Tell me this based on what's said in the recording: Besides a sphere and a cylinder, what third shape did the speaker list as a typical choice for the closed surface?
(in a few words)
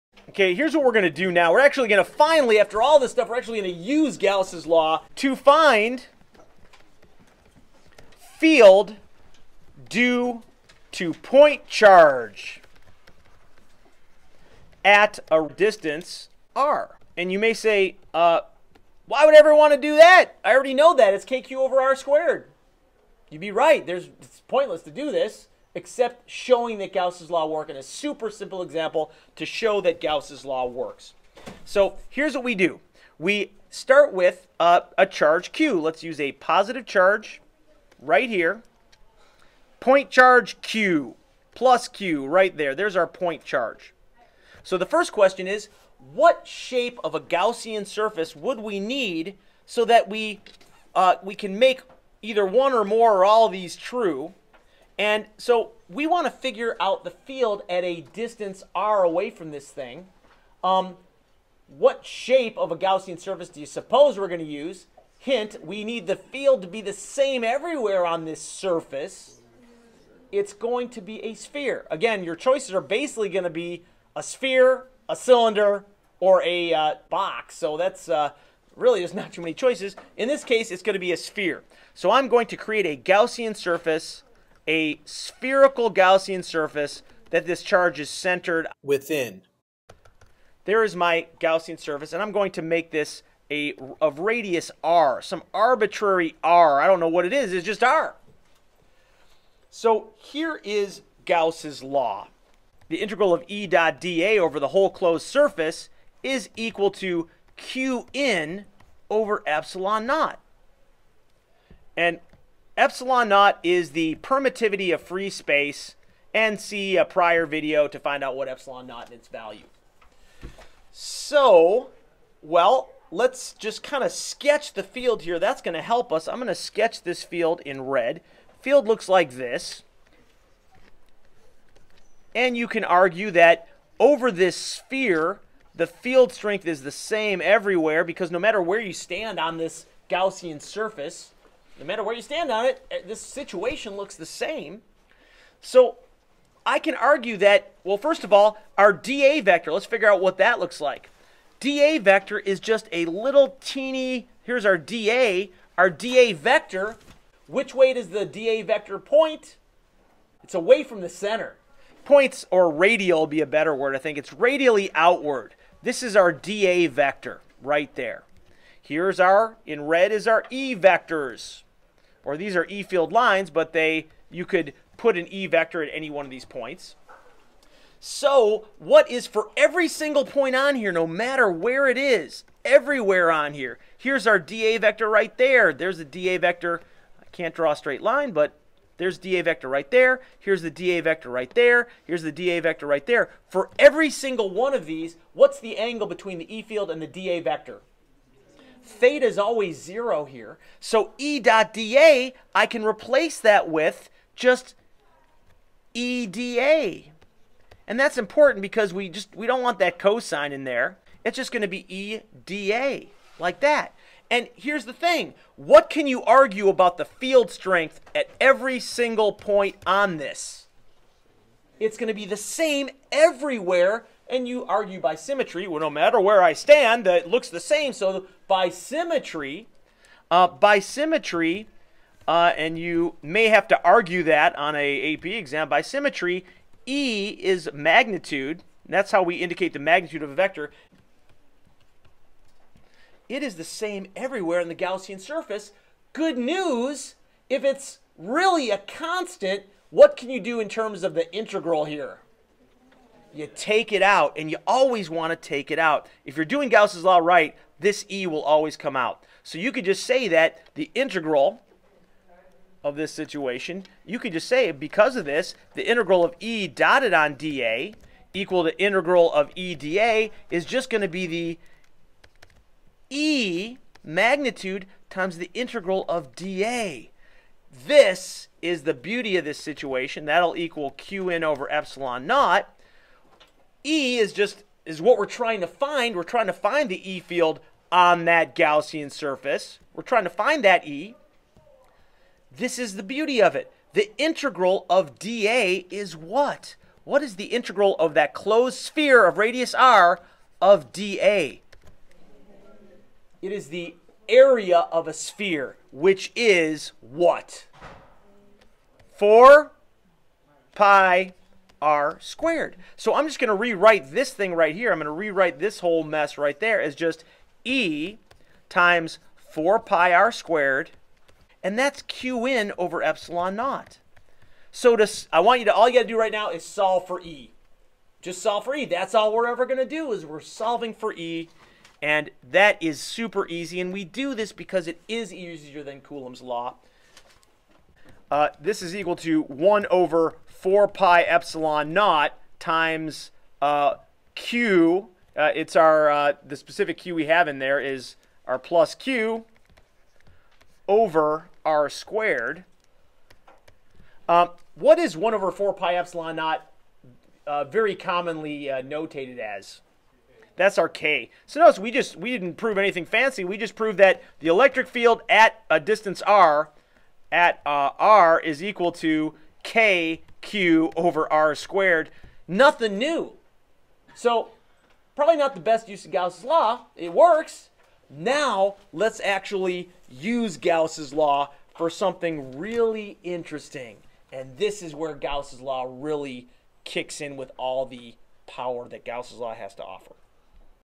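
box.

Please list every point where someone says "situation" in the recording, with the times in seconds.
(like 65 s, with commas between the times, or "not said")
143 s, 263 s, 279 s.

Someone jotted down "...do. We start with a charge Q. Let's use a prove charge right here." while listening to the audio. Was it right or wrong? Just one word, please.
wrong.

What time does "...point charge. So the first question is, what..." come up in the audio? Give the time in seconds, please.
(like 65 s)
43 s.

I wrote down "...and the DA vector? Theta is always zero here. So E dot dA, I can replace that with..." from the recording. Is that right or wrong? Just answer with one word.
right.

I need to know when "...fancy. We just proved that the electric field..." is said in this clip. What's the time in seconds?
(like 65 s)
363 s.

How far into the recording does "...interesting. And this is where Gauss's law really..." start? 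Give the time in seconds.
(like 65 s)
383 s.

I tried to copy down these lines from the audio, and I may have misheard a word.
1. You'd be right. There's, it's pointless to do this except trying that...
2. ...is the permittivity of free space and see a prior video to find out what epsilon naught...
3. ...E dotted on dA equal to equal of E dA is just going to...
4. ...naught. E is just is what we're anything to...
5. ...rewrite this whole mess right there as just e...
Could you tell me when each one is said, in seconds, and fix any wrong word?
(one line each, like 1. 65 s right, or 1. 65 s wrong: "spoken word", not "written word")
1. 23 s wrong: "showing", not "trying"
2. 113 s right
3. 266 s wrong: "integral", not "equal"
4. 282 s wrong: "trying", not "anything"
5. 315 s right.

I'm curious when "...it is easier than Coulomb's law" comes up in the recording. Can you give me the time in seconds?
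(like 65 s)
334 s.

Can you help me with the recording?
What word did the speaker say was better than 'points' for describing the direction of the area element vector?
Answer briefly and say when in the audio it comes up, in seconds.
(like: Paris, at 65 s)
radial, at 162 s.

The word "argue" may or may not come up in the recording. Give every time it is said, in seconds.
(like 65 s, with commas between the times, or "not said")
132 s, 146 s, 216 s, 224 s, 233 s.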